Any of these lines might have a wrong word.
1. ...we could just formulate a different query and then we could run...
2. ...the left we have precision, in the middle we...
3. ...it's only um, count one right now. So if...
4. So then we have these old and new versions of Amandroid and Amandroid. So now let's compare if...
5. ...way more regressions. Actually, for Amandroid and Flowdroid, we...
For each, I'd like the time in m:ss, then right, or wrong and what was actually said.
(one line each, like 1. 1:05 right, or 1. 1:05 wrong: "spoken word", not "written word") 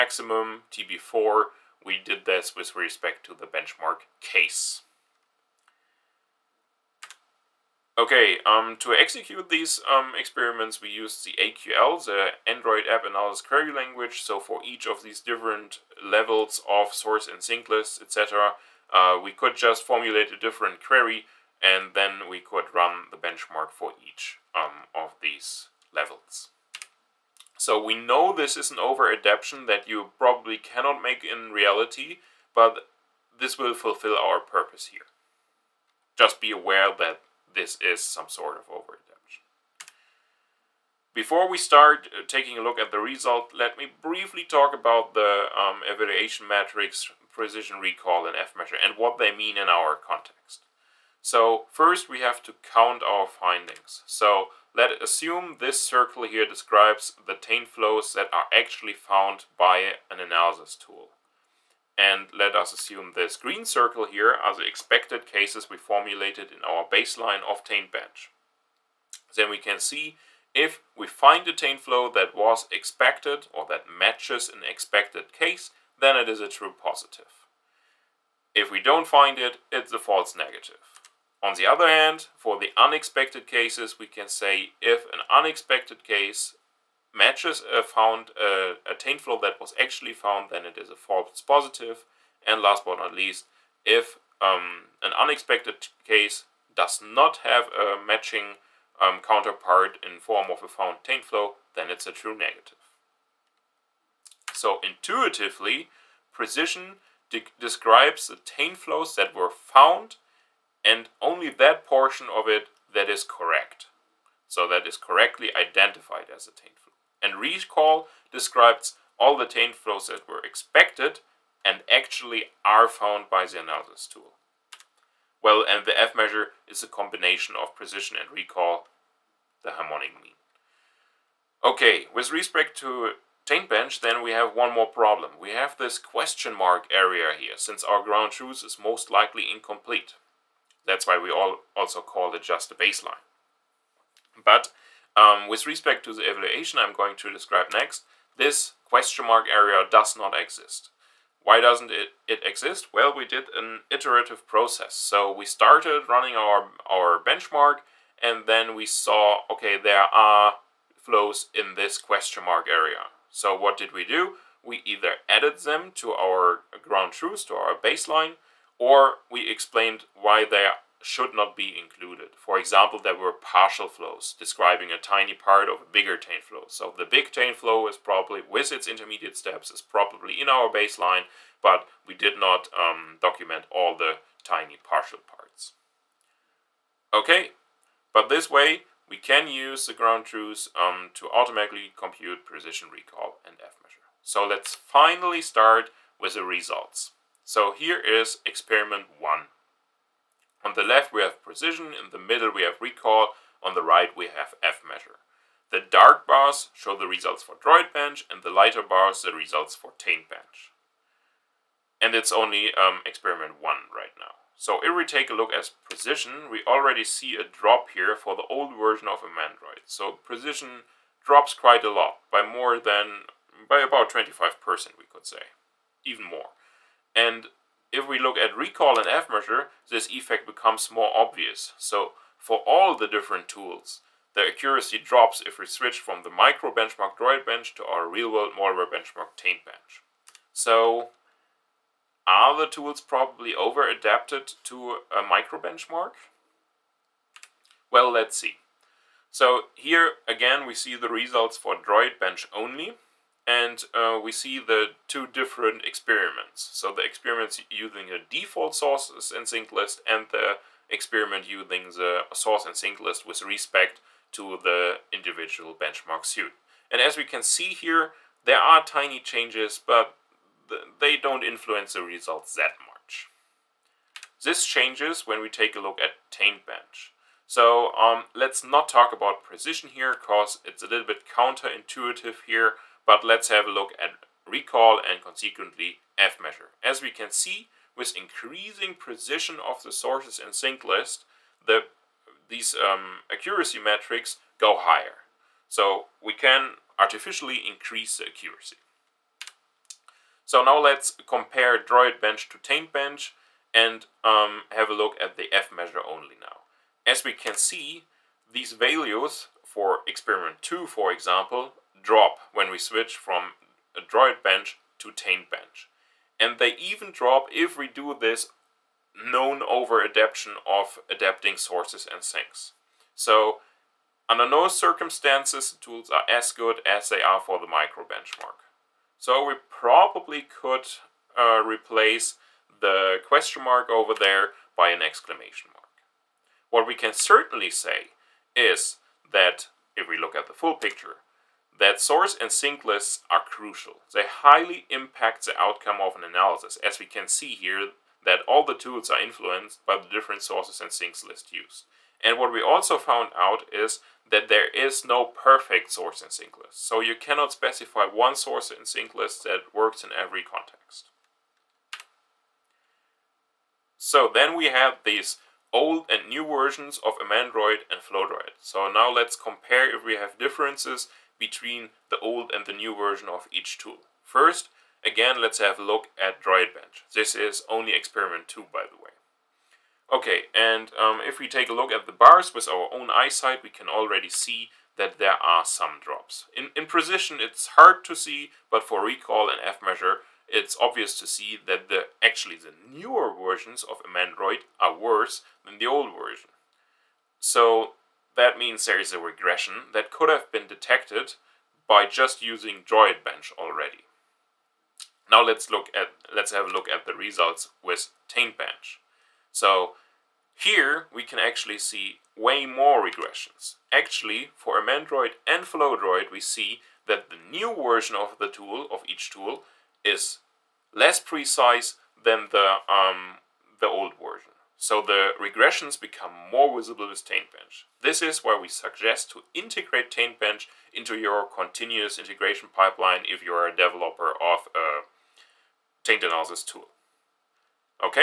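1. 0:19 right
2. 3:20 right
3. 3:32 wrong: "experiment", not "count"
4. 6:03 wrong: "Flowdroid", not "Amandroid"
5. 6:52 right.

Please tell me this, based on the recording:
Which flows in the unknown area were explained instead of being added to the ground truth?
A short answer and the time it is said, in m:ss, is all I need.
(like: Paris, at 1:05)
Partial flows, at 2:53.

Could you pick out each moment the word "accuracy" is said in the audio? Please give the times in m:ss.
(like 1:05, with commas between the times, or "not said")
3:54, 4:53, 4:58.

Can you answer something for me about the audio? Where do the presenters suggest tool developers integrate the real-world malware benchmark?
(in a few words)
Continuous integration pipeline.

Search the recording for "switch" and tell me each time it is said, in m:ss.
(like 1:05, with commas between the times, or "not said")
3:55, 5:12.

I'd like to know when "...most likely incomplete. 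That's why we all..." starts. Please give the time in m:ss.
2:18.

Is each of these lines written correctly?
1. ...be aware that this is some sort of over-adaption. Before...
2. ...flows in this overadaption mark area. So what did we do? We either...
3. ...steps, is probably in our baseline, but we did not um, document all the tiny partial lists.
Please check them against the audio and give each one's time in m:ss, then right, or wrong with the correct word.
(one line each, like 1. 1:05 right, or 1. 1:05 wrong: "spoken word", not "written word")
1. 0:36 right
2. 2:40 wrong: "question", not "overadaption"
3. 2:59 wrong: "parts", not "lists".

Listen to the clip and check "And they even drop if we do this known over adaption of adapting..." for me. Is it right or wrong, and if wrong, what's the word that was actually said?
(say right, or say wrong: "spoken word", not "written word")
right.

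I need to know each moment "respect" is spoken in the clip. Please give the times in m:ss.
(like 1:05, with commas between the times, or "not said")
0:02, 2:12, 2:25, 4:23.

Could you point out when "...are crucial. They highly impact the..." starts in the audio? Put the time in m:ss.
5:43.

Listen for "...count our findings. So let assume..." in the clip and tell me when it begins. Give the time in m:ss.
0:52.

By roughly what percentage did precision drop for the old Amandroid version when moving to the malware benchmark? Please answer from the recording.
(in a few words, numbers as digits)
25%.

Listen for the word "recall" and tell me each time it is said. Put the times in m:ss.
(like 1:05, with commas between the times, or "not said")
0:47, 1:57, 2:08, 3:12, 3:22, 3:48, 4:44, 6:29.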